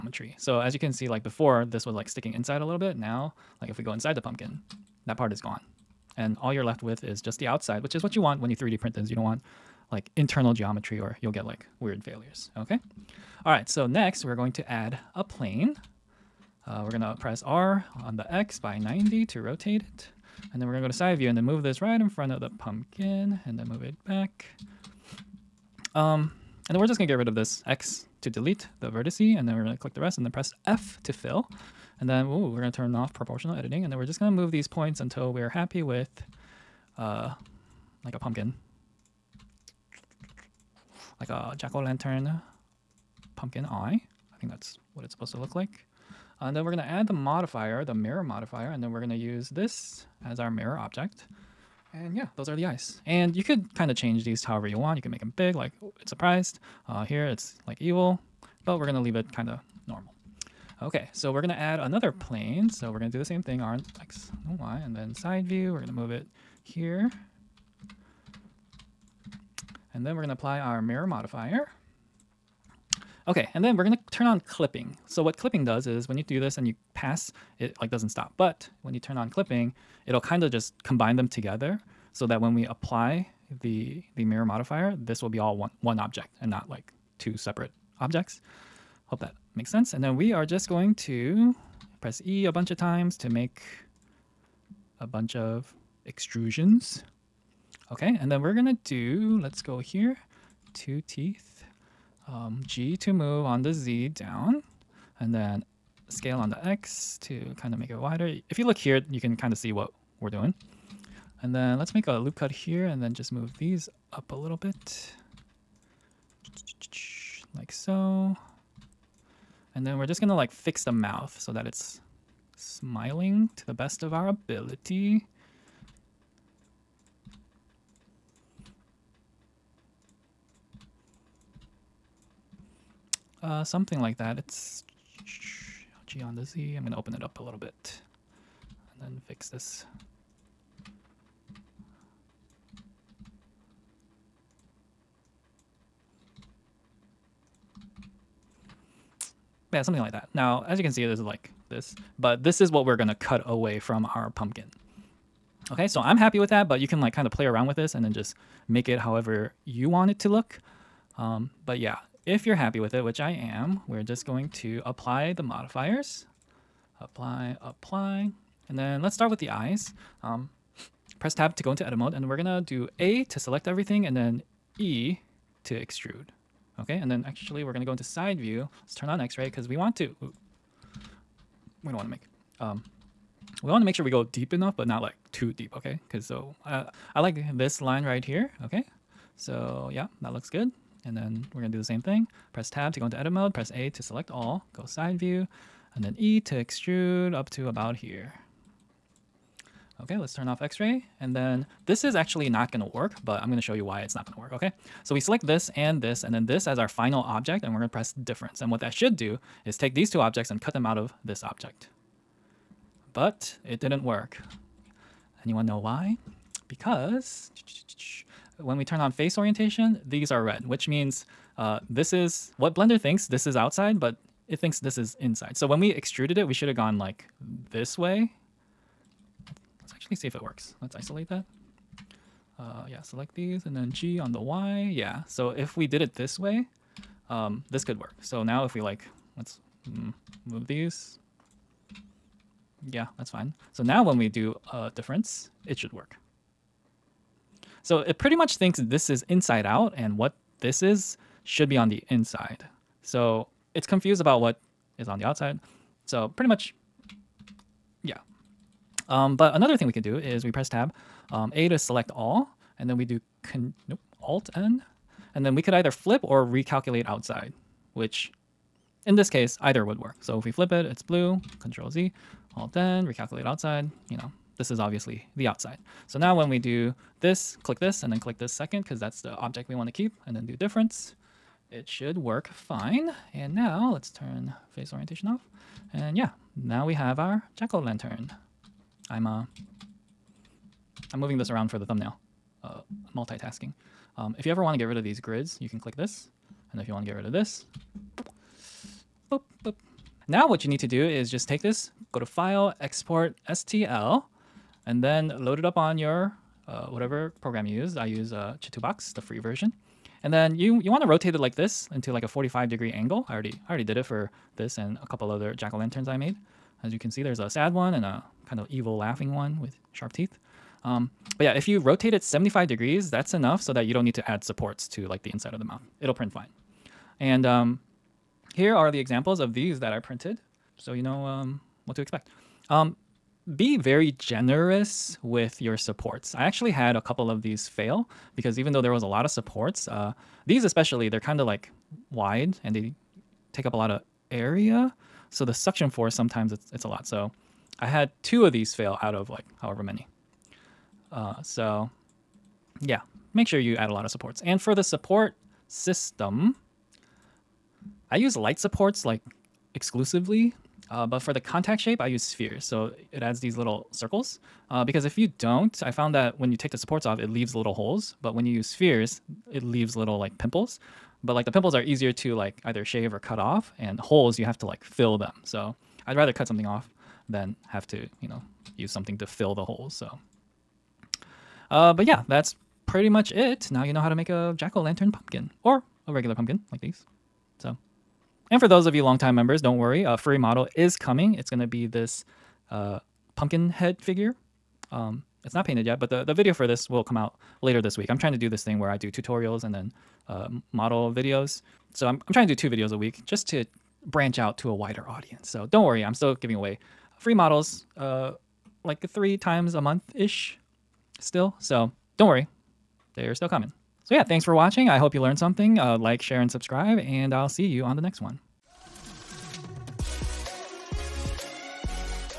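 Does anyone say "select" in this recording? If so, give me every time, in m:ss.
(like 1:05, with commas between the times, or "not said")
2:53, 3:14, 3:25, 3:53, 4:21.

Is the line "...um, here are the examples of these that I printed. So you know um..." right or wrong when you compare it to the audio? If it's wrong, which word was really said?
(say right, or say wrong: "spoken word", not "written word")
right.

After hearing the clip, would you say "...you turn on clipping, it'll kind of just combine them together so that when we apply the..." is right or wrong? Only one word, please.
right.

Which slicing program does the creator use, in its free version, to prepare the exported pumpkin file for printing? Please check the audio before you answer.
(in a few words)
Chitubox.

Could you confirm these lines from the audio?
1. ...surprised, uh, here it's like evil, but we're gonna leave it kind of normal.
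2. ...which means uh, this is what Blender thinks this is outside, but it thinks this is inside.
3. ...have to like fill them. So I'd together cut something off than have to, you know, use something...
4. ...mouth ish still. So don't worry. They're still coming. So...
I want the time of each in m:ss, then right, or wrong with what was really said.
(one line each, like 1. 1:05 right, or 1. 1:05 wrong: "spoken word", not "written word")
1. 0:56 right
2. 3:40 right
3. 6:14 wrong: "rather", not "together"
4. 6:49 wrong: "month", not "mouth".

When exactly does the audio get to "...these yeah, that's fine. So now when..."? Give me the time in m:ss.
4:00.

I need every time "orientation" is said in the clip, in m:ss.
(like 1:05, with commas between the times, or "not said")
3:39, 4:44.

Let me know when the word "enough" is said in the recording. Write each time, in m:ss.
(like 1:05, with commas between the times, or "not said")
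3:04, 5:23.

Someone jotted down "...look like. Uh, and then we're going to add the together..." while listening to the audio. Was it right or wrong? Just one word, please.
wrong.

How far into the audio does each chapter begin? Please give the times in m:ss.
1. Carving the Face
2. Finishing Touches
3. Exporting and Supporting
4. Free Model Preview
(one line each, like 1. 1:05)
1. 0:13
2. 3:20
3. 4:59
4. 6:27.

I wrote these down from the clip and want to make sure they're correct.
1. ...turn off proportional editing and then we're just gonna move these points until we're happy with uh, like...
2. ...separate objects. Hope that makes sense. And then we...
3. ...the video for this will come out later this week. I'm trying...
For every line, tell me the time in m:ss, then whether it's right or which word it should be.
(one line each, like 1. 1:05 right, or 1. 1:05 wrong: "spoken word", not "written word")
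1. 0:32 right
2. 1:27 right
3. 6:36 right.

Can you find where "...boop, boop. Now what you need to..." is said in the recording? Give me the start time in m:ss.
4:59.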